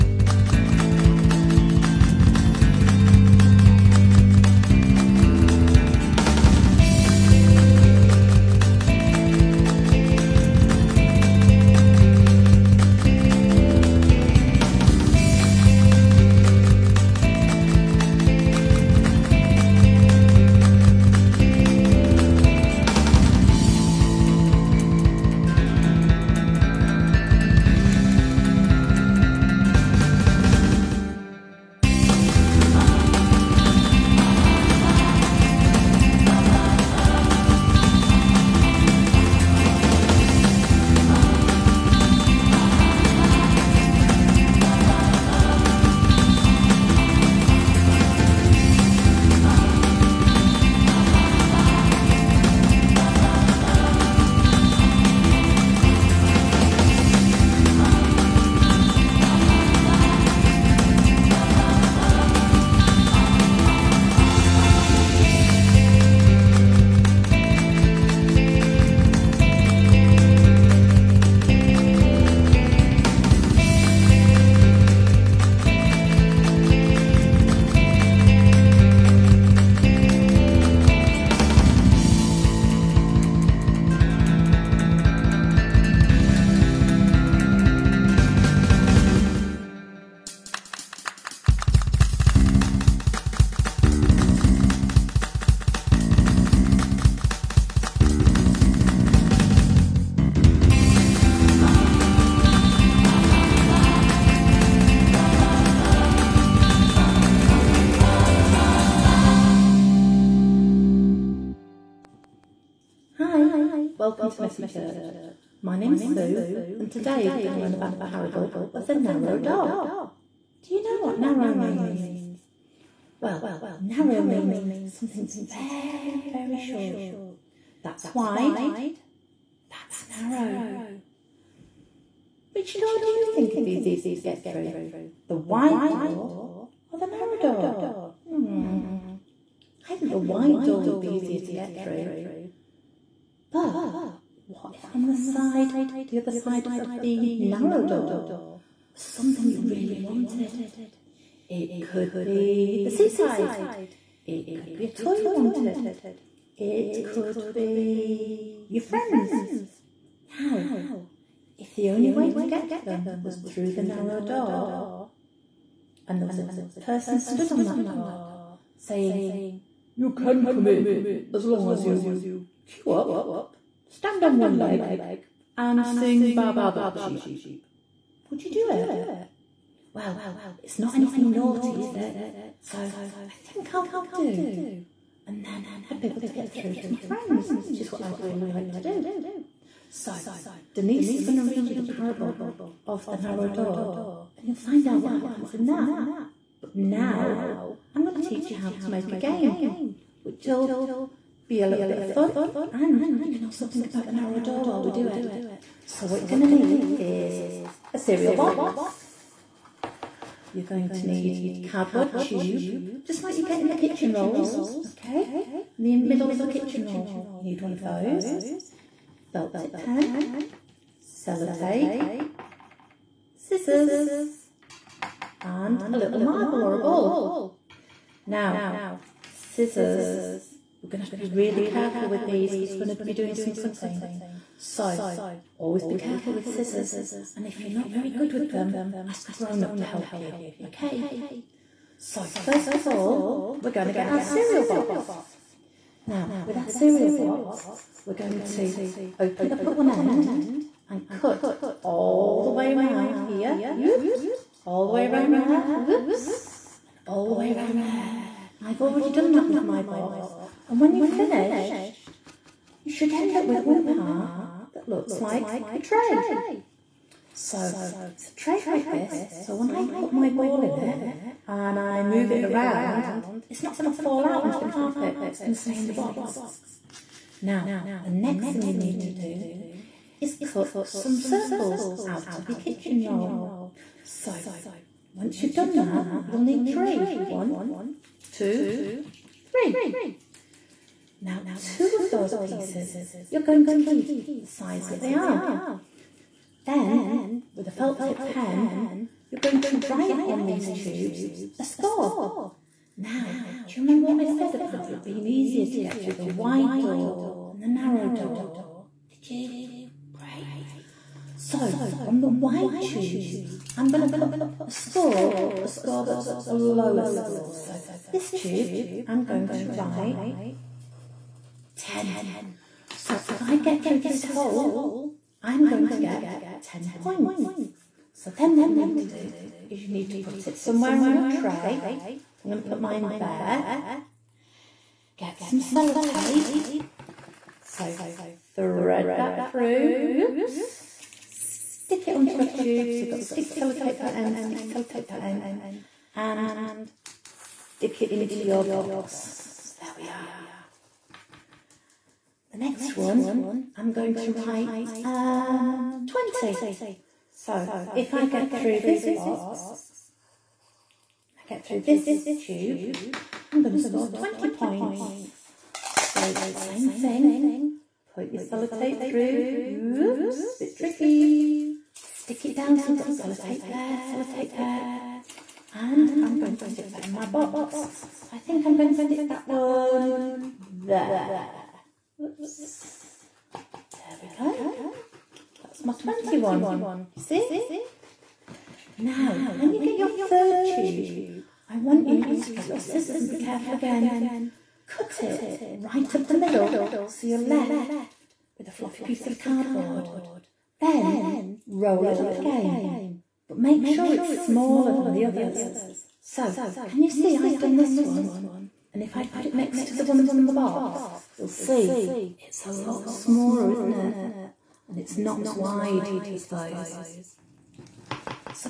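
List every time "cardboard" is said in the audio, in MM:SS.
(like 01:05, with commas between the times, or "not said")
03:31, 06:39.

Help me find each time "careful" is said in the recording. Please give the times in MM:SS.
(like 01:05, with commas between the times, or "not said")
03:51, 03:55, 06:33.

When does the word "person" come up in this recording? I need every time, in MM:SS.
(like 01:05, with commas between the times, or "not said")
02:46.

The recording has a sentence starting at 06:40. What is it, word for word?
Then roll it up again, but make sure it's smaller than the others.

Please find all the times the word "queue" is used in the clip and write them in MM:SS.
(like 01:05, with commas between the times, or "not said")
02:52.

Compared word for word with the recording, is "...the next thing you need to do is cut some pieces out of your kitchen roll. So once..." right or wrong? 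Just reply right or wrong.
wrong.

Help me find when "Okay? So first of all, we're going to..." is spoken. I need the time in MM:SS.
04:00.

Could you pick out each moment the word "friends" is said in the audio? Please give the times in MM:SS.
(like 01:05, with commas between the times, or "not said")
02:38, 03:07.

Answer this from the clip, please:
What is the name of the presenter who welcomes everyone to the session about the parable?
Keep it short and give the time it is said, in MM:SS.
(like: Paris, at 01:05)
Sue, at 01:56.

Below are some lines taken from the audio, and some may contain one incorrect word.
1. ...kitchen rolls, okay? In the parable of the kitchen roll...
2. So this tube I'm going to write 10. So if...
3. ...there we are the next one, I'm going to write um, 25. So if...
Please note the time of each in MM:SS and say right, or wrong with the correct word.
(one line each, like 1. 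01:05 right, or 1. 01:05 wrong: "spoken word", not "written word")
1. 03:33 wrong: "middle", not "parable"
2. 05:17 right
3. 05:49 wrong: "20", not "25".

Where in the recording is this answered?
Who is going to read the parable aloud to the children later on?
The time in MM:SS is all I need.
03:10.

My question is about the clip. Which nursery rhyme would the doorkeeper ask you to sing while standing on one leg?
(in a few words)
Ba Ba Black Sheep.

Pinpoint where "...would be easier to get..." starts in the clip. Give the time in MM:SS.
02:20.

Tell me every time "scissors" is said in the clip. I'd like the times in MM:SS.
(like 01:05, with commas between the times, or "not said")
03:43, 03:49, 03:56, 06:32.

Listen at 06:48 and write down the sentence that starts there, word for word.
And if I put it next to the ones on the box, you'll see it's a lot smaller, isn't it?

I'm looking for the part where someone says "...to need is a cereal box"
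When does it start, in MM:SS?
03:26.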